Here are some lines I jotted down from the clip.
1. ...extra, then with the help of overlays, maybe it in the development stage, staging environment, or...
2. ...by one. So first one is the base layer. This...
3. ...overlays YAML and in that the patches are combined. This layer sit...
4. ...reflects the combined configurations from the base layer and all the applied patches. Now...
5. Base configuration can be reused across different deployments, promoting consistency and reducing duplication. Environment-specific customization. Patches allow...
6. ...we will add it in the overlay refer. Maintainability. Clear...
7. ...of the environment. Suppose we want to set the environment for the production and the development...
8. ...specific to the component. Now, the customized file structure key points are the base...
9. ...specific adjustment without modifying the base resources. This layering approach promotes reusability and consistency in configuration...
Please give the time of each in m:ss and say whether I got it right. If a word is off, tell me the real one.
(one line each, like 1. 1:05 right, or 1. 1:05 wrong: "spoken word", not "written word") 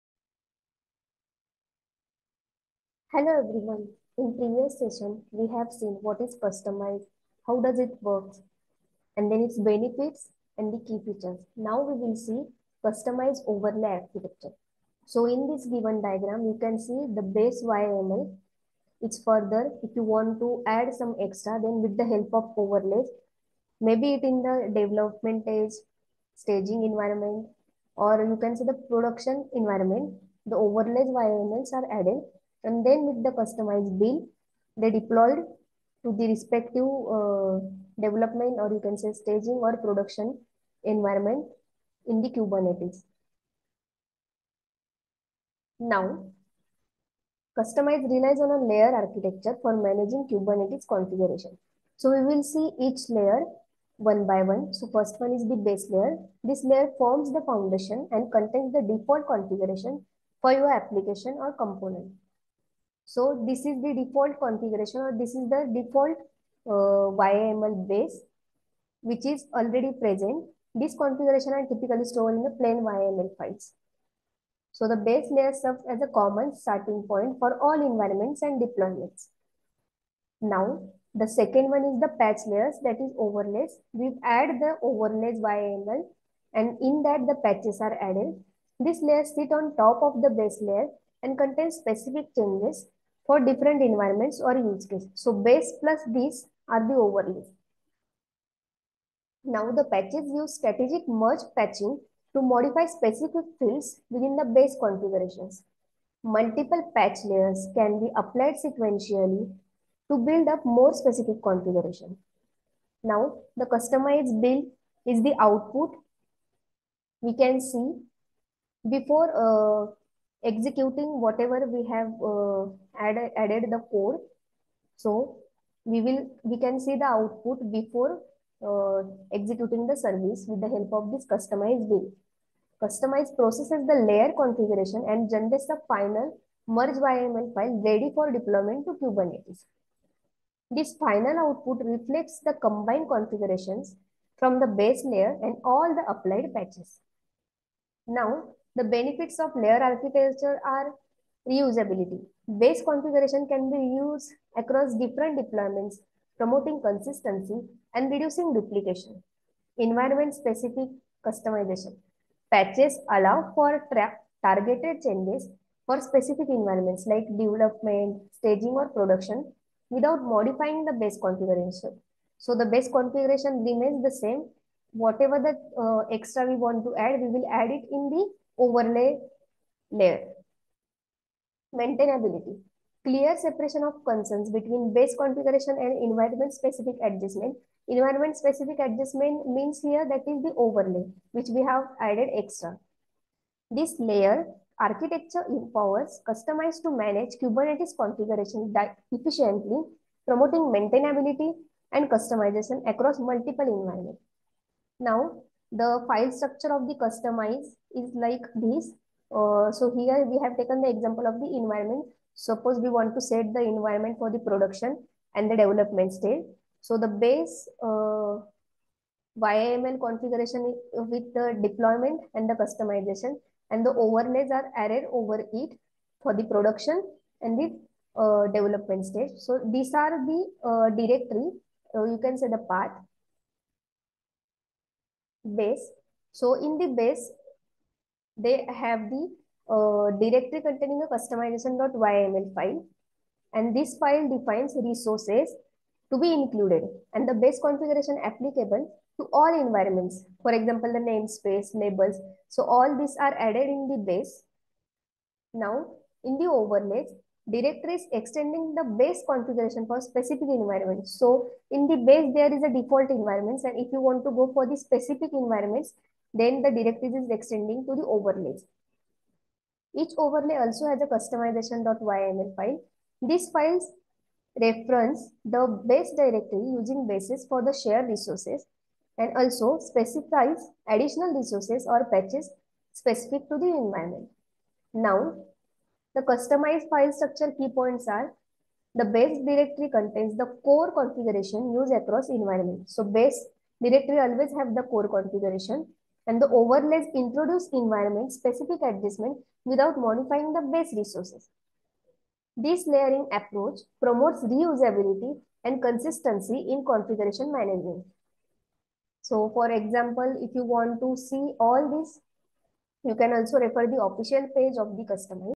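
1. 0:21 right
2. 0:54 right
3. 1:24 wrong: "added", not "combined"
4. 2:21 right
5. 2:32 right
6. 2:57 wrong: "layer", not "refer"
7. 3:31 right
8. 4:42 wrong: "environment", not "component"
9. 4:58 right.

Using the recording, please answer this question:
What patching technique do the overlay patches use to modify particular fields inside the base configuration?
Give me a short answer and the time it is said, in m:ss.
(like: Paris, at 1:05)
strategic merge patching, at 1:40.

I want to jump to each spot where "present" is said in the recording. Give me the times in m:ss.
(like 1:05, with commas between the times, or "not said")
1:09.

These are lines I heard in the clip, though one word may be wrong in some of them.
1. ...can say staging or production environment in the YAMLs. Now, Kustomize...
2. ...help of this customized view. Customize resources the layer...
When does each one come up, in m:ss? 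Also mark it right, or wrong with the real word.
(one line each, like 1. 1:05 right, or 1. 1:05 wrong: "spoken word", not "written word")
1. 0:38 wrong: "Kubernetes", not "YAMLs"
2. 2:10 wrong: "processes", not "resources".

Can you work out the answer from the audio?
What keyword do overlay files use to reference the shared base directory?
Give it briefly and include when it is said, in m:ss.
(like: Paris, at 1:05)
bases, at 4:37.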